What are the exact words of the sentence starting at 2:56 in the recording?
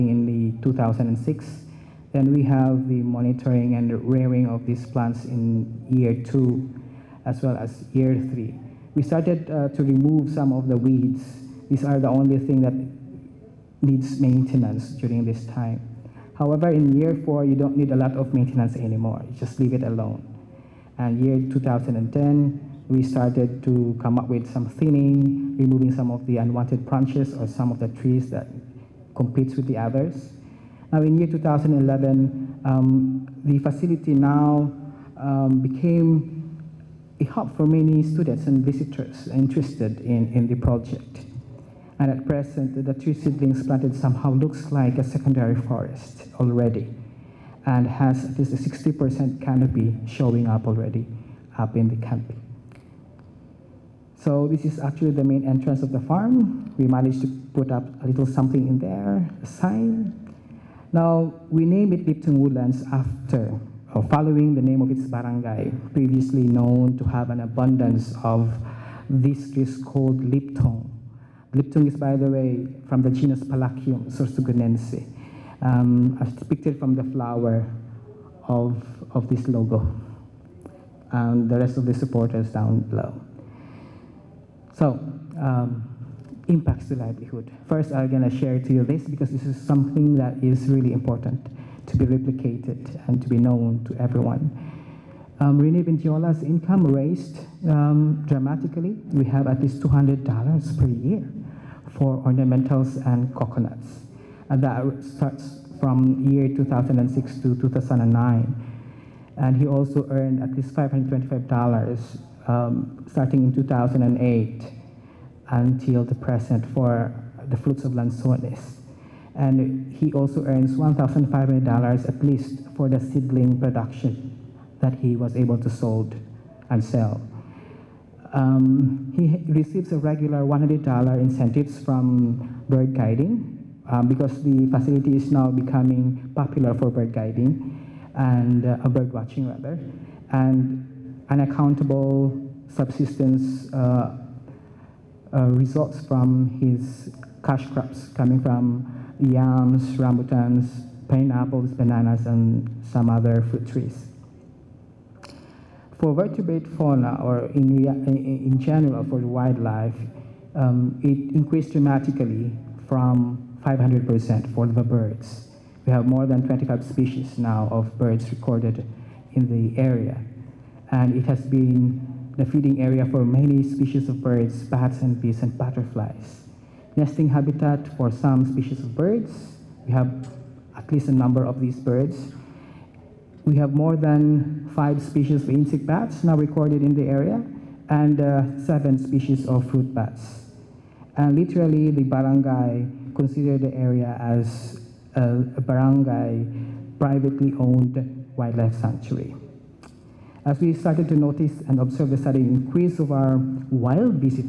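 Nesting habitat for some species of birds.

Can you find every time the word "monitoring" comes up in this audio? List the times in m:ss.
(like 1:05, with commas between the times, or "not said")
0:03.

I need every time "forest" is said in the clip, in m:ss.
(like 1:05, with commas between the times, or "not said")
0:45.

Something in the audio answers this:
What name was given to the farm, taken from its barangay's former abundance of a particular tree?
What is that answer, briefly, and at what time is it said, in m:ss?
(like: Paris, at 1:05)
Liptong Woodlands, at 1:02.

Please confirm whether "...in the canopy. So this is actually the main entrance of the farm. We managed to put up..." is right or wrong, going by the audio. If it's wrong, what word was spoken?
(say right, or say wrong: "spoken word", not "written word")
right.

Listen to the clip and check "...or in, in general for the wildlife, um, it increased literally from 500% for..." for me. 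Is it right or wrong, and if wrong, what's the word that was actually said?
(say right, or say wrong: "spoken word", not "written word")
wrong: "dramatically", not "literally".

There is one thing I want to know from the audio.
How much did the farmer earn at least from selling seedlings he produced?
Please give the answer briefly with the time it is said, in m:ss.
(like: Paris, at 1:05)
$1,500, at 2:00.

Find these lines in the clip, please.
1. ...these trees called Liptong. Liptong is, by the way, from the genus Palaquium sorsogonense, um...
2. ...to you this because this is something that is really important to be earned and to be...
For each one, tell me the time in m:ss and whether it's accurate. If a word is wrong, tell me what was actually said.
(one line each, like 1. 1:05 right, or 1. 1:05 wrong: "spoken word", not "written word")
1. 1:09 right
2. 1:28 wrong: "replicated", not "earned".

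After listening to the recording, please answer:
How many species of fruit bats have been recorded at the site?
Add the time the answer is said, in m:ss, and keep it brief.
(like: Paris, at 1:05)
7, at 3:08.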